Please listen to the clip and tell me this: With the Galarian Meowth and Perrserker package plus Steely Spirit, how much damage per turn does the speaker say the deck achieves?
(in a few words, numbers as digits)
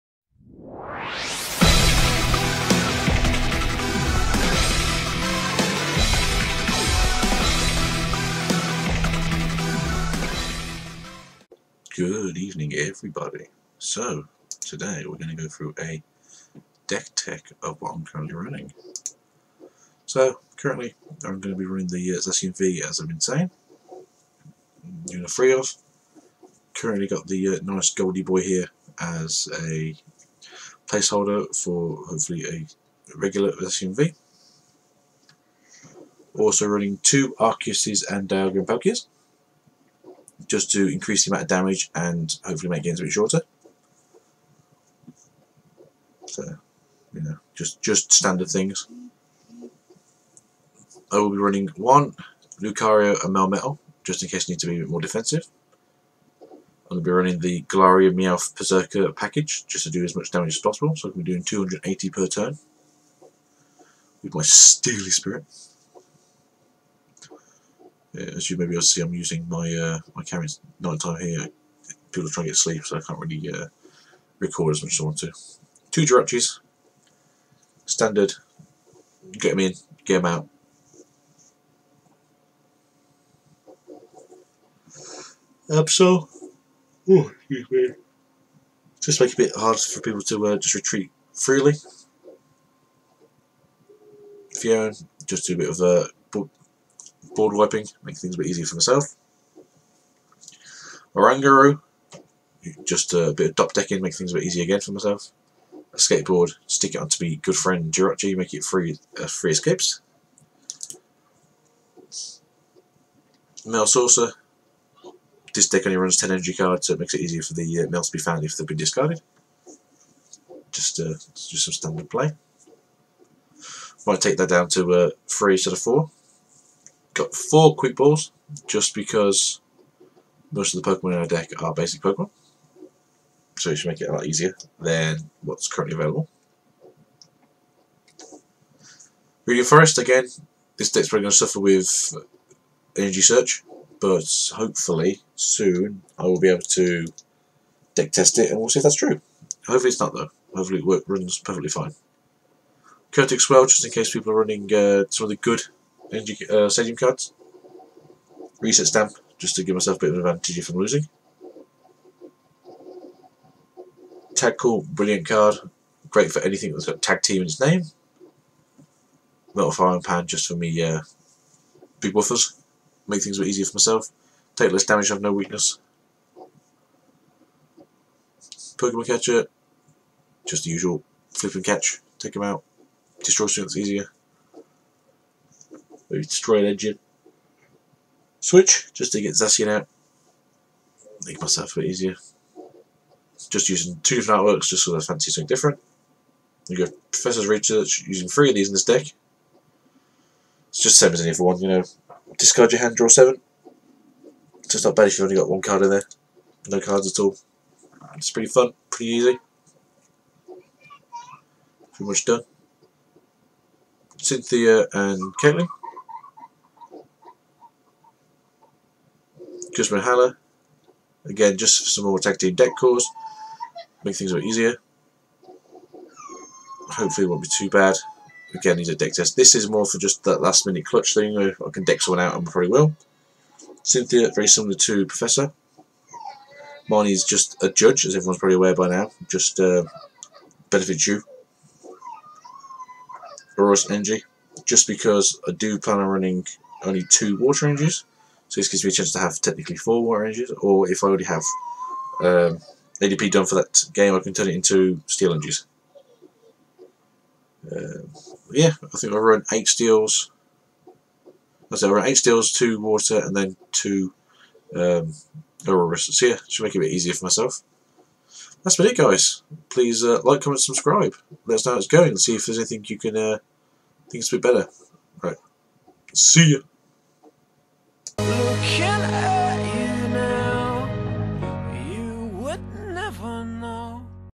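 280.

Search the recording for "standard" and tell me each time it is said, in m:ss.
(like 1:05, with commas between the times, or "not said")
0:48, 1:17, 2:01.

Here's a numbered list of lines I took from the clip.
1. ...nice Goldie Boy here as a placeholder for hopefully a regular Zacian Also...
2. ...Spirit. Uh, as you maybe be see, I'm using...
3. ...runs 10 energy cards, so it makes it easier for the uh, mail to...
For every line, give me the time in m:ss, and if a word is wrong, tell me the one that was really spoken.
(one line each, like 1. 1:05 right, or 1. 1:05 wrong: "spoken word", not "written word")
1. 0:27 right
2. 1:05 right
3. 1:55 right.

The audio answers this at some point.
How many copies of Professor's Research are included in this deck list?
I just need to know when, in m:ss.
3:18.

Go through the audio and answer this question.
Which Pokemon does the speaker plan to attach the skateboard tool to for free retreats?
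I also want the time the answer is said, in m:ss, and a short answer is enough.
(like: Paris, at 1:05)
Jirachi, at 1:47.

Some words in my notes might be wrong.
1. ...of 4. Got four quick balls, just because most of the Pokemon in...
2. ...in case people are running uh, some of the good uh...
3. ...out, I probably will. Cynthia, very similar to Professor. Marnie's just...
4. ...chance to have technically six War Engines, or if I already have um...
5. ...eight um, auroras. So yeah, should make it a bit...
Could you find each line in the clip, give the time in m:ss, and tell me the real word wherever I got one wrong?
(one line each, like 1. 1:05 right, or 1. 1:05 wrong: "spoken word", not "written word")
1. 2:05 right
2. 2:33 right
3. 3:52 right
4. 4:08 wrong: "four", not "six"
5. 4:23 wrong: "two", not "eight".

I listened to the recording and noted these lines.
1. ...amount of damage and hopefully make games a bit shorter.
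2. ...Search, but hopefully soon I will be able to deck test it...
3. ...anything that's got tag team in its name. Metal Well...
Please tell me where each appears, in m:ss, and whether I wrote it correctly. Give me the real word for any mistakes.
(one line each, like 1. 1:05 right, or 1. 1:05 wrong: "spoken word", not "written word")
1. 0:41 right
2. 2:23 right
3. 2:46 wrong: "Frying", not "Well".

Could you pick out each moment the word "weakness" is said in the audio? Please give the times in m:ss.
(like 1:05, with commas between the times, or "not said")
2:55.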